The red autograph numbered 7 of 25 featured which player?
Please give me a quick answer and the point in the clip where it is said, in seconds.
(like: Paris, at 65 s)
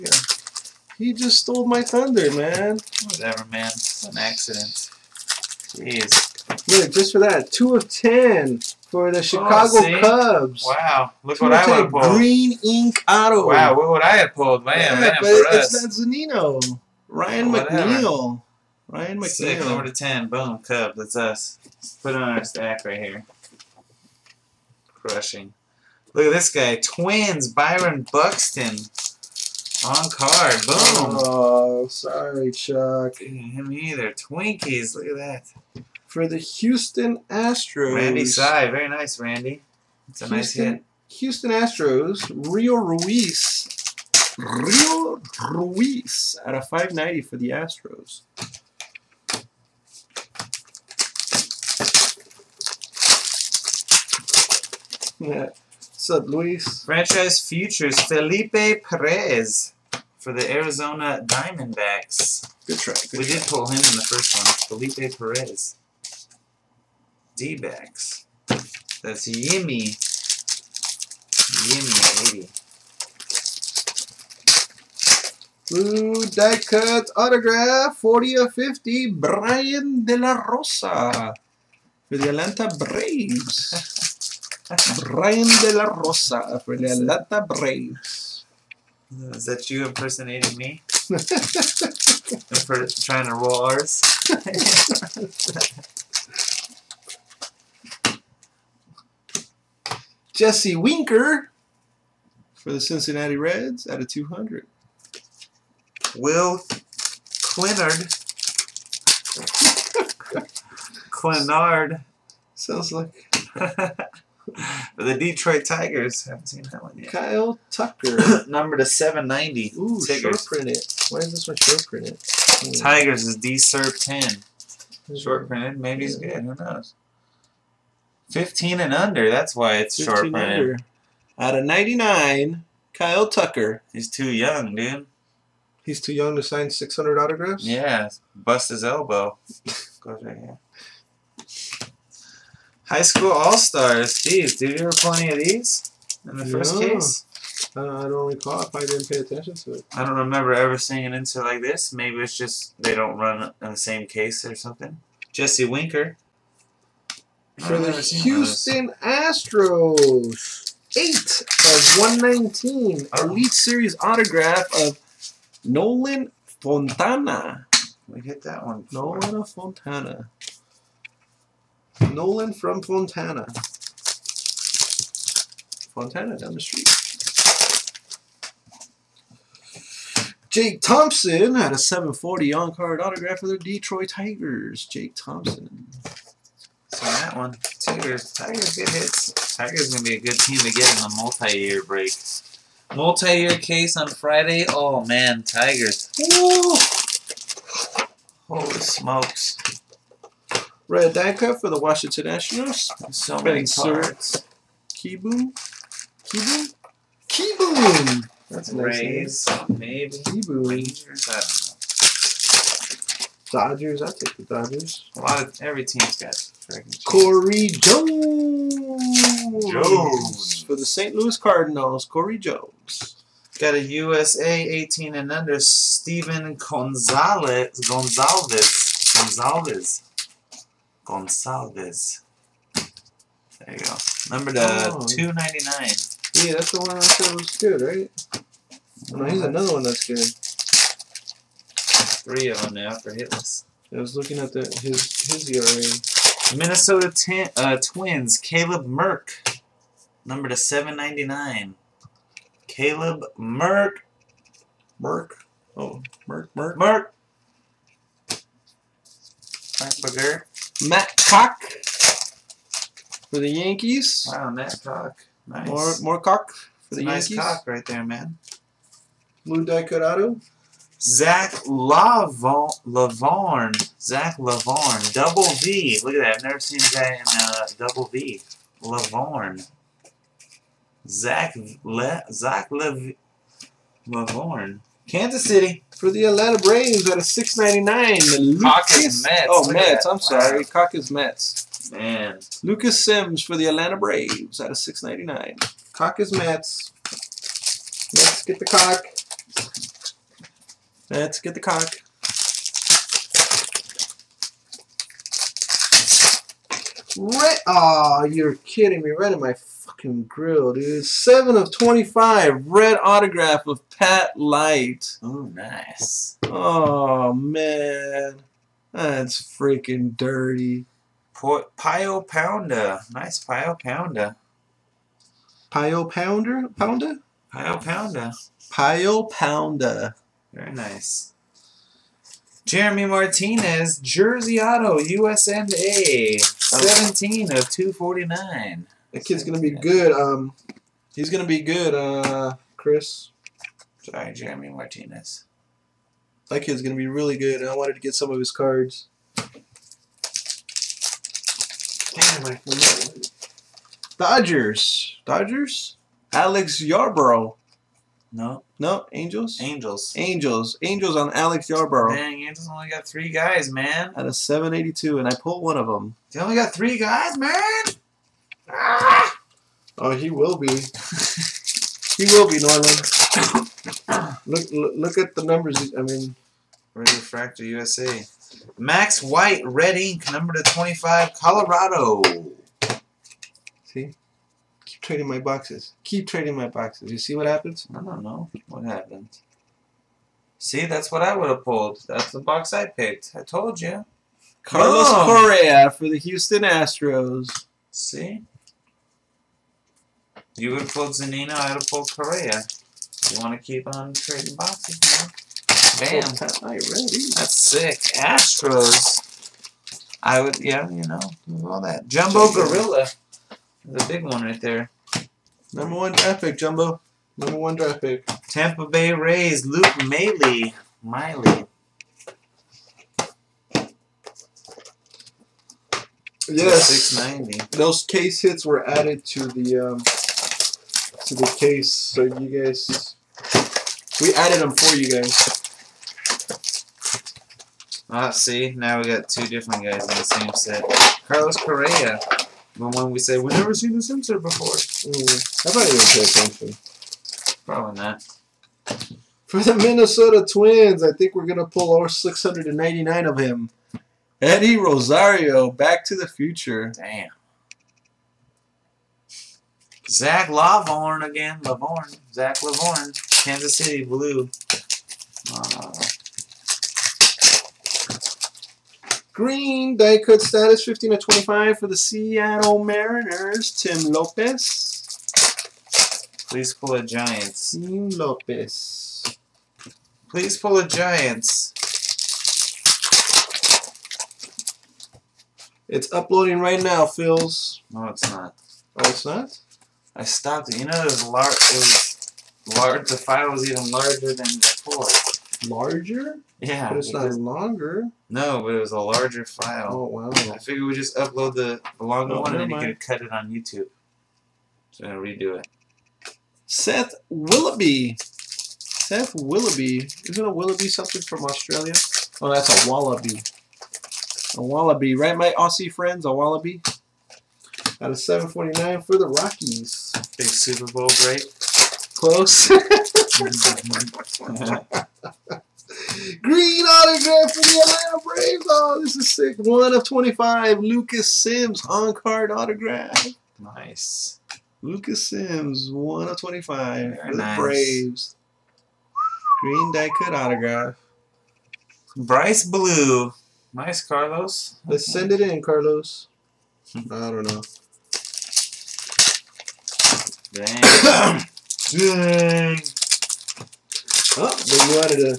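Pat Light, at 313 s.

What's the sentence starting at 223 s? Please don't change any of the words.
Got a USA 18 and under, Steven Gonzalez.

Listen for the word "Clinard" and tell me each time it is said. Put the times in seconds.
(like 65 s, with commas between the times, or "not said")
106 s, 111 s.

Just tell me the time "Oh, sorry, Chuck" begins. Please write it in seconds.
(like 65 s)
31 s.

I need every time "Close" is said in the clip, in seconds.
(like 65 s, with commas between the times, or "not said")
522 s.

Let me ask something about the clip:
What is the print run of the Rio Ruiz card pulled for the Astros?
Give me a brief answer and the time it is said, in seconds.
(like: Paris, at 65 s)
590, at 46 s.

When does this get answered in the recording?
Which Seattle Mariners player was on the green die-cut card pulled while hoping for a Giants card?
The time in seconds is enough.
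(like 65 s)
473 s.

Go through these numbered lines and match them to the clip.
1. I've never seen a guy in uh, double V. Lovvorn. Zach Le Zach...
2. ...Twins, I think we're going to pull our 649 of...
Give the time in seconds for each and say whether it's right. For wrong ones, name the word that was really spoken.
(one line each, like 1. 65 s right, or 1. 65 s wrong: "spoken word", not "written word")
1. 276 s right
2. 450 s wrong: "699", not "649".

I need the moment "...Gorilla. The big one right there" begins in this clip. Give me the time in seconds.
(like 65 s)
412 s.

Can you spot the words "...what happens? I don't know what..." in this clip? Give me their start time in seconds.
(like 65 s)
387 s.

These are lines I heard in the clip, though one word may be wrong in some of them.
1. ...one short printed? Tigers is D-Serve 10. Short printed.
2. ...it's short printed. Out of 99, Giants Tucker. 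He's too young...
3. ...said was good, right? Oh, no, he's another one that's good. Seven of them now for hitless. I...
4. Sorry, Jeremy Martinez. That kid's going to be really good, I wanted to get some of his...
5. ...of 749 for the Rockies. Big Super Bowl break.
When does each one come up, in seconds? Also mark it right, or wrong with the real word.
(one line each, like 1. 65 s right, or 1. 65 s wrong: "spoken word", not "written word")
1. 121 s right
2. 129 s wrong: "Kyle", not "Giants"
3. 237 s wrong: "Three", not "Seven"
4. 344 s right
5. 518 s right.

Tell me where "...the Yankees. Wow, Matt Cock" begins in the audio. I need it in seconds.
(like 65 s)
263 s.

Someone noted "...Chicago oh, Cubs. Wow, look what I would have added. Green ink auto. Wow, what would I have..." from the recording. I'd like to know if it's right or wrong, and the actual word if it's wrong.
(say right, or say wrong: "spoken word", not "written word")
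wrong: "pulled", not "added".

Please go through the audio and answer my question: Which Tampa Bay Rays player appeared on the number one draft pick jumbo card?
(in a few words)
Luke Maile.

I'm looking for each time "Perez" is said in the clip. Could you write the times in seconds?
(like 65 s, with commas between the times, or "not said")
58 s, 65 s.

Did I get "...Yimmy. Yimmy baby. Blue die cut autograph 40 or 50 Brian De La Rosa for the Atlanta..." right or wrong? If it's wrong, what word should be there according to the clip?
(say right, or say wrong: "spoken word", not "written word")
right.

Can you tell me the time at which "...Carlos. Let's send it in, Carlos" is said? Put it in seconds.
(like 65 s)
544 s.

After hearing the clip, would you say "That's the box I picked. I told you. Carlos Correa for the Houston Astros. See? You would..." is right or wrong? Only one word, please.
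right.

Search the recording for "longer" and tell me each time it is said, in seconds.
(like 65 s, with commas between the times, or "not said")
497 s, 501 s.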